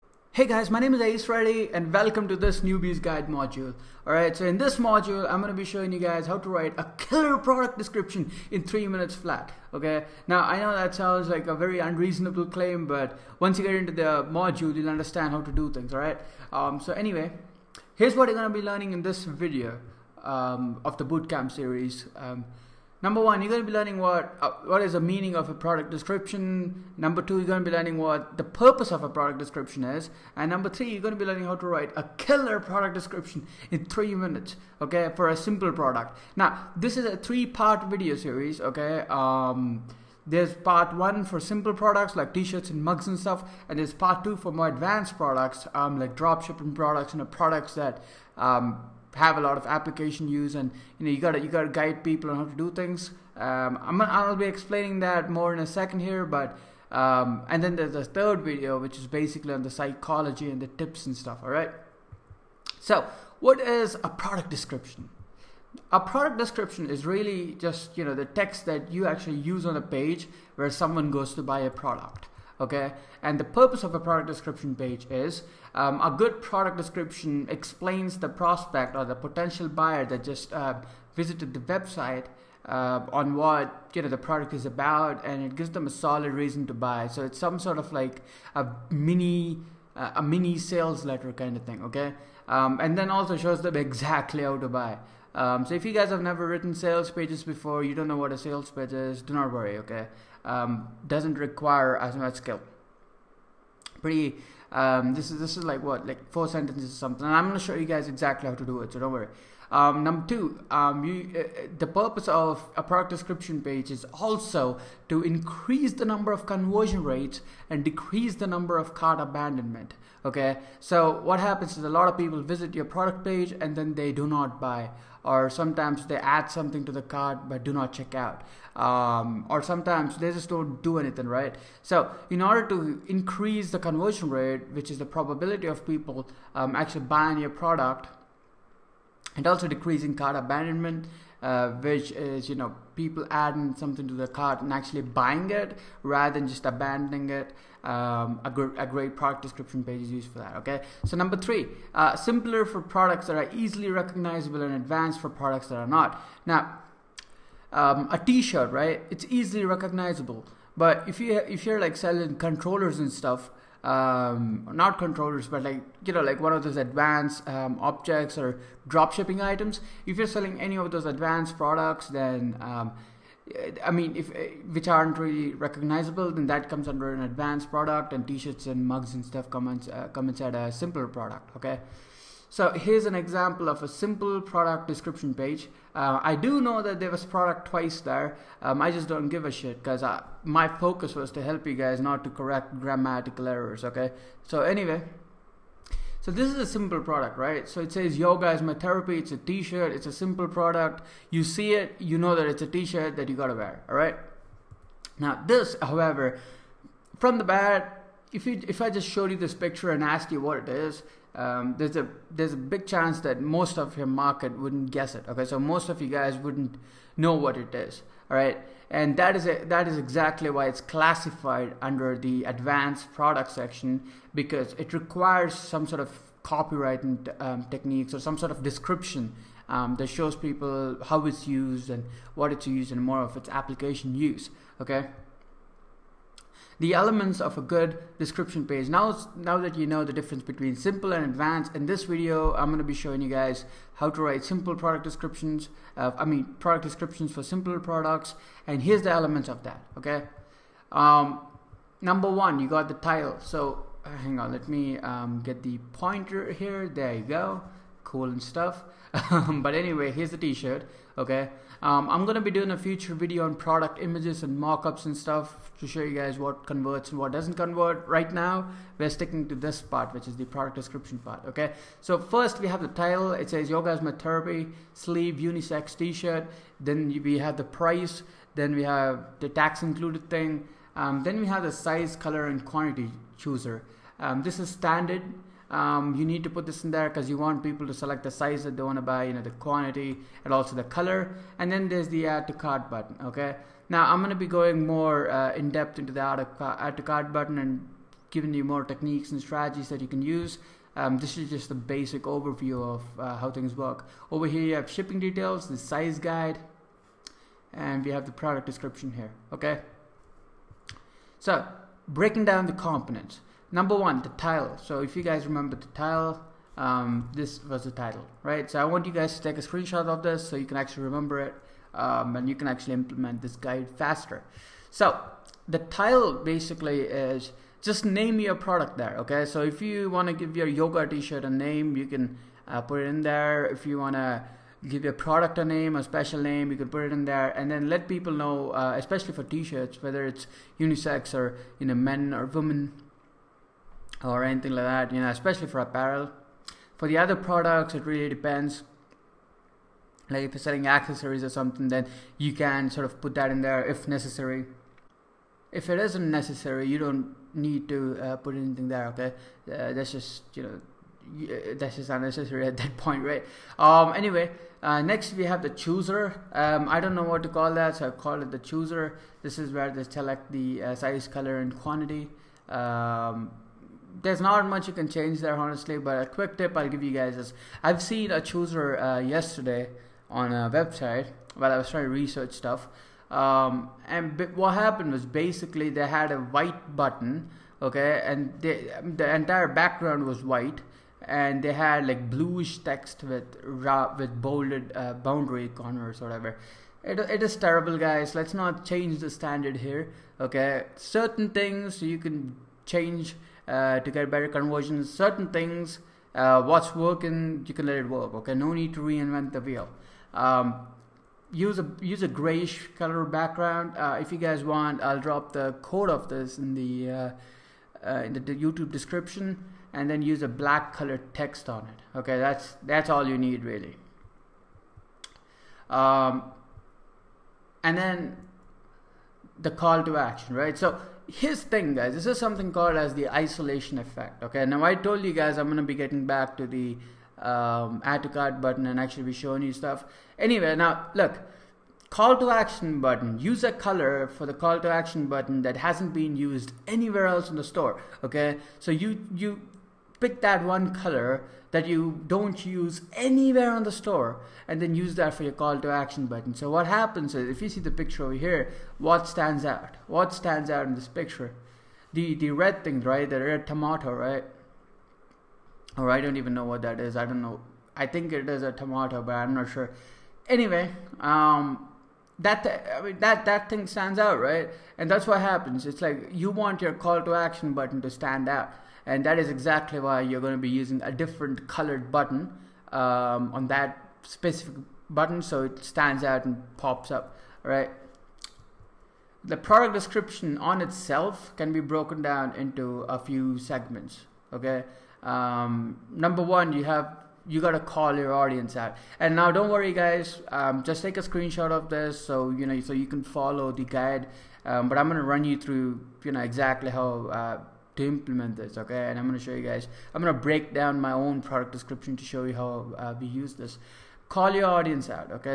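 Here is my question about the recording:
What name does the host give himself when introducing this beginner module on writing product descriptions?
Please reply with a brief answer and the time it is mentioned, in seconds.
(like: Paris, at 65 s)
Ace, at 1 s.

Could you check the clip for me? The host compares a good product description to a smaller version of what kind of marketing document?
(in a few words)
sales letter.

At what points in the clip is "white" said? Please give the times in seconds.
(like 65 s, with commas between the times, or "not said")
386 s, 390 s.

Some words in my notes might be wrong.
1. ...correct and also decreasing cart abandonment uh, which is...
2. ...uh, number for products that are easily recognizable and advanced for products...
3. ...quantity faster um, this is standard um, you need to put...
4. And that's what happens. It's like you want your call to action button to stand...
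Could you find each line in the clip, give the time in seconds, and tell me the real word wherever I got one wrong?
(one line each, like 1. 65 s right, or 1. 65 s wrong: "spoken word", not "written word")
1. 137 s wrong: "product", not "correct"
2. 151 s wrong: "simpler", not "number"
3. 282 s wrong: "chooser", not "faster"
4. 474 s right.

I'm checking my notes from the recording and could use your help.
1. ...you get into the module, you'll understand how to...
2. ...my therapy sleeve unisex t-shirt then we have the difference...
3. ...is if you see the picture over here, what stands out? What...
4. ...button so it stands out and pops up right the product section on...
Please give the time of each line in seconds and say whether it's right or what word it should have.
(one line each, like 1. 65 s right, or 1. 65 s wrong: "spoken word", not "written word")
1. 13 s right
2. 274 s wrong: "price", not "difference"
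3. 457 s right
4. 485 s wrong: "description", not "section".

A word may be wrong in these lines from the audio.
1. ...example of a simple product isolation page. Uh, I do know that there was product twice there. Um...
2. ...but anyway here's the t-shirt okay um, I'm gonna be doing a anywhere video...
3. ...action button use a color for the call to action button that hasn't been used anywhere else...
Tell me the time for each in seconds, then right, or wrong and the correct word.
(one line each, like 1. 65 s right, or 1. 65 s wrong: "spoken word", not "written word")
1. 183 s wrong: "description", not "isolation"
2. 259 s wrong: "future", not "anywhere"
3. 442 s right.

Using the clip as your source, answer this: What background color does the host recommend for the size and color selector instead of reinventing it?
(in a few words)
grayish.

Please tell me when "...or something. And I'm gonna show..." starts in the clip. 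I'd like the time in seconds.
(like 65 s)
106 s.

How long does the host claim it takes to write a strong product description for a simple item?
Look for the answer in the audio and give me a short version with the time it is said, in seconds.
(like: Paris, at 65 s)
3 minutes, at 8 s.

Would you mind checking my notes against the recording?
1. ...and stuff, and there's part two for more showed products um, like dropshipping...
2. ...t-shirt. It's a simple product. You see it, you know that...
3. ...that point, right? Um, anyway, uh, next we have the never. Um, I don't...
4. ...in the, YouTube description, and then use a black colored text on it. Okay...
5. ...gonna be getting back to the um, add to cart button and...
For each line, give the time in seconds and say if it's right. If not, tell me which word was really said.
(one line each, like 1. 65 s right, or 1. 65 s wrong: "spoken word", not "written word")
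1. 43 s wrong: "advanced", not "showed"
2. 199 s right
3. 362 s wrong: "chooser", not "never"
4. 418 s right
5. 435 s right.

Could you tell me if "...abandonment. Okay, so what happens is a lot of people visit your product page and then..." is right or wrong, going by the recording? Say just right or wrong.
right.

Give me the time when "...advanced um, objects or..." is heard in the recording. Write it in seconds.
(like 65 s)
166 s.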